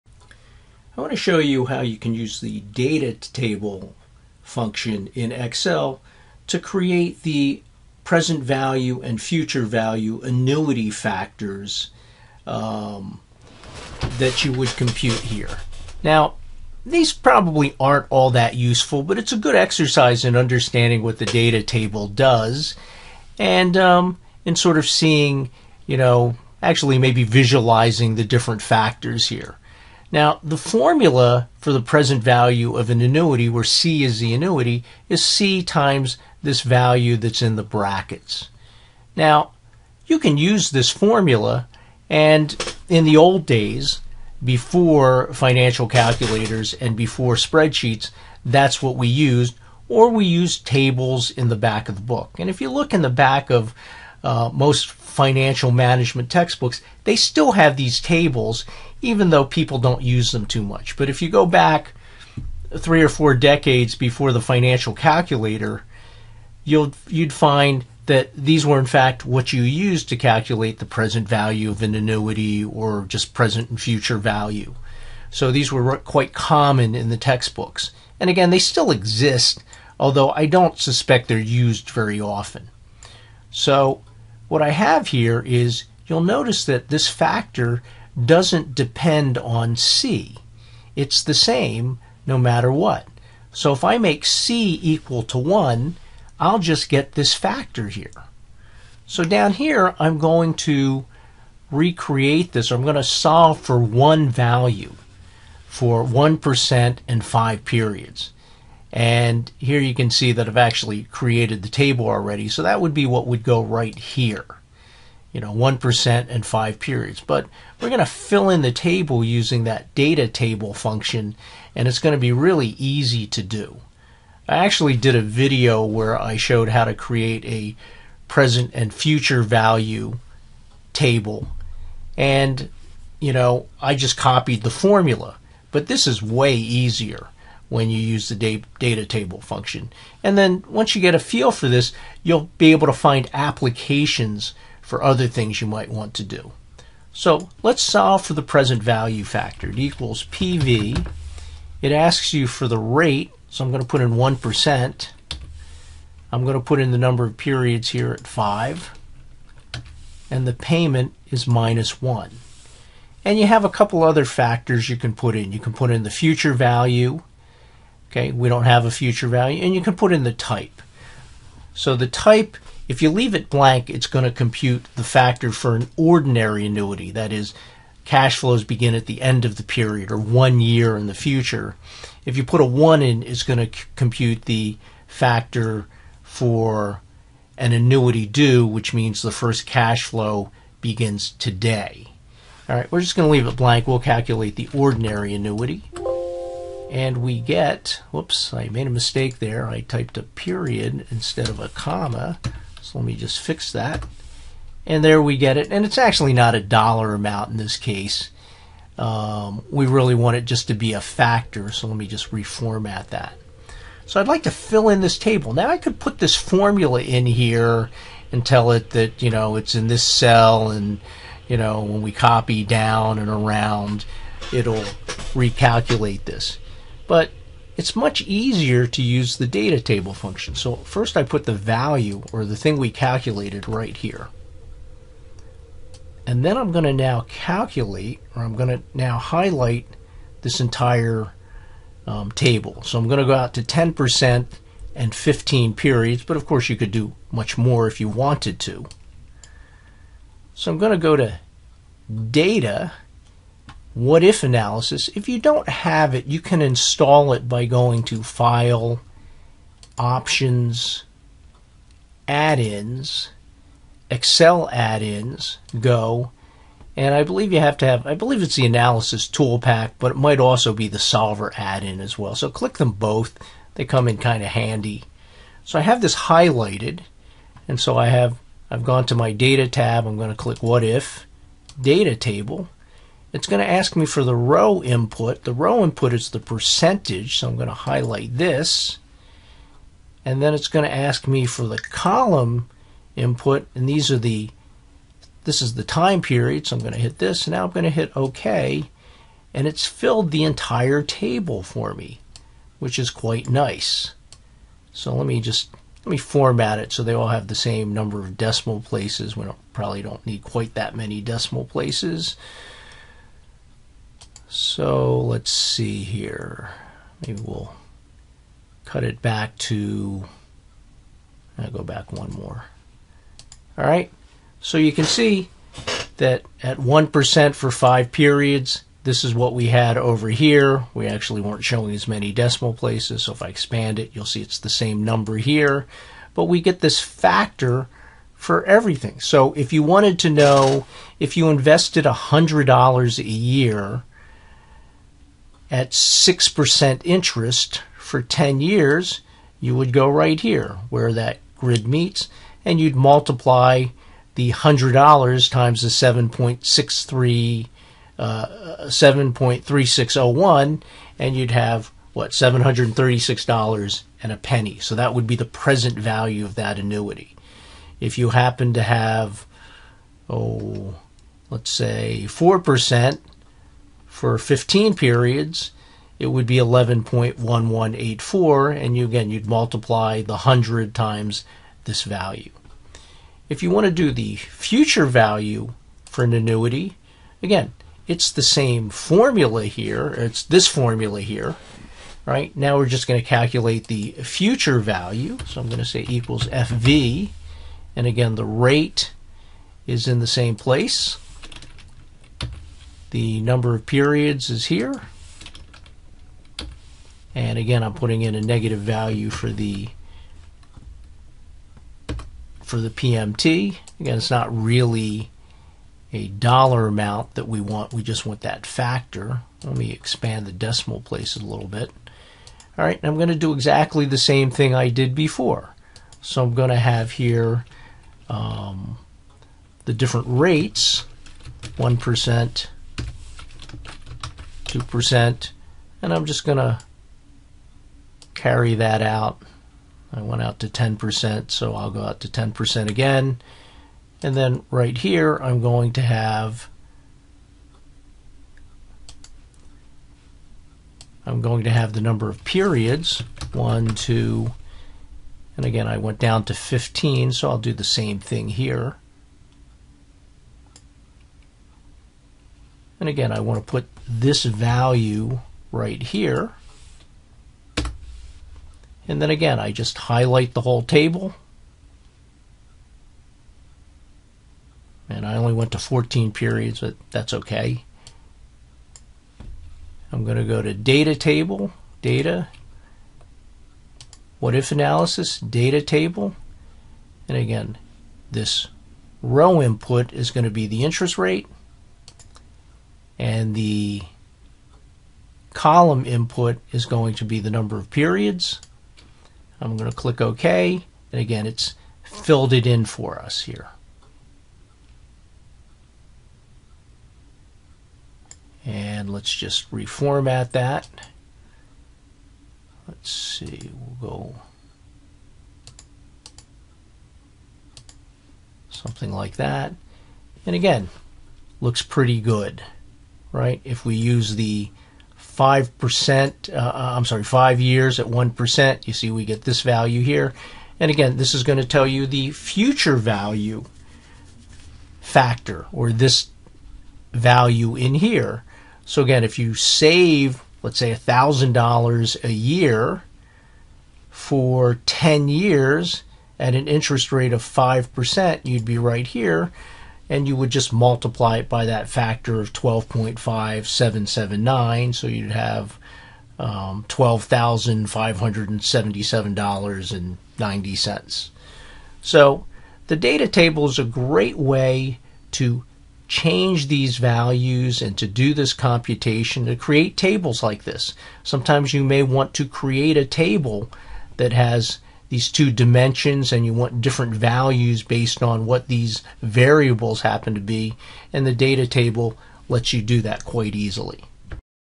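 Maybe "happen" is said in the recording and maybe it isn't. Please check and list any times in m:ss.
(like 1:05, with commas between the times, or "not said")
6:08, 9:40.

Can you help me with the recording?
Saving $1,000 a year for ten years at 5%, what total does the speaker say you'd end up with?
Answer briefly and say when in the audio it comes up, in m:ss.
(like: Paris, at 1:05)
$12,577.90, at 9:16.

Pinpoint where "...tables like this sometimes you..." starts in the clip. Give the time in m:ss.
9:29.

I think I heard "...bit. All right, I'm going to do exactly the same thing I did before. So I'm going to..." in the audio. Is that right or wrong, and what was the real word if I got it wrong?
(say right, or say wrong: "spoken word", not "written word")
right.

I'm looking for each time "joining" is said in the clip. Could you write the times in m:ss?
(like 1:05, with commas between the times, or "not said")
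not said.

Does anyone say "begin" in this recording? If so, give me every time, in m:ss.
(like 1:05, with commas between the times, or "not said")
2:58, 3:10.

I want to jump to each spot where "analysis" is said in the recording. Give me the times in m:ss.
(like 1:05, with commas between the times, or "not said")
4:14, 4:28, 8:04.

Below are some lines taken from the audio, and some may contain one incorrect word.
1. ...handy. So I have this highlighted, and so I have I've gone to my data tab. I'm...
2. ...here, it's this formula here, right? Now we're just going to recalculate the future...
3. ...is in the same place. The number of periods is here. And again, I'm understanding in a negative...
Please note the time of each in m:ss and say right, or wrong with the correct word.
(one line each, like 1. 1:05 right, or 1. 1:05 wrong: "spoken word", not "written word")
1. 4:34 right
2. 6:29 wrong: "calculate", not "recalculate"
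3. 6:39 wrong: "putting", not "understanding".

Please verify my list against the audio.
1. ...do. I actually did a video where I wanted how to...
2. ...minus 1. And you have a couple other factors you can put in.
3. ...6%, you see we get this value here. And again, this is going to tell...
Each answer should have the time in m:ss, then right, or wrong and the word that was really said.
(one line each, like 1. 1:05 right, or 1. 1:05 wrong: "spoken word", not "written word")
1. 2:03 wrong: "showed", not "wanted"
2. 2:41 right
3. 8:48 wrong: "1", not "6".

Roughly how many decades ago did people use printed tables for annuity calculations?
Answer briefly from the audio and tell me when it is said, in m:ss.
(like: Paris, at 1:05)
3 or 4, at 1:02.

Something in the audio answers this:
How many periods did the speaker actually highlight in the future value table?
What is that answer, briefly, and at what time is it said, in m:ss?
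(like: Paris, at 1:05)
14, at 7:55.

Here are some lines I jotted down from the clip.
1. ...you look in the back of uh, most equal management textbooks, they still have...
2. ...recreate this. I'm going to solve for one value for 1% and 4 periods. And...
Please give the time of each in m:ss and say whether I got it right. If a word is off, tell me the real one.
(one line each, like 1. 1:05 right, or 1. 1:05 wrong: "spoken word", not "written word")
1. 0:52 wrong: "financial", not "equal"
2. 1:41 wrong: "5", not "4".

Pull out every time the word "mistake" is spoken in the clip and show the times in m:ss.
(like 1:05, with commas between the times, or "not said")
3:18.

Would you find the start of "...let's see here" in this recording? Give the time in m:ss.
5:15.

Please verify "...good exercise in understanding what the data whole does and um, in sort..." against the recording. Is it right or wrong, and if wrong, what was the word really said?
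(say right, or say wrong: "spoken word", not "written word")
wrong: "table", not "whole".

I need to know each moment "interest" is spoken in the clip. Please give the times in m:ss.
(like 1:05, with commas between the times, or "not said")
5:47, 8:10, 9:06.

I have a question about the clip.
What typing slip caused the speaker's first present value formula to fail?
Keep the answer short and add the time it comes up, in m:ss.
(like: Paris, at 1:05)
A period instead of a comma, at 3:20.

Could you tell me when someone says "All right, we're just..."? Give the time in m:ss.
3:12.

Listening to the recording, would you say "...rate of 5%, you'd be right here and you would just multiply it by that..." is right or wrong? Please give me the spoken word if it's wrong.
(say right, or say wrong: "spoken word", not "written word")
right.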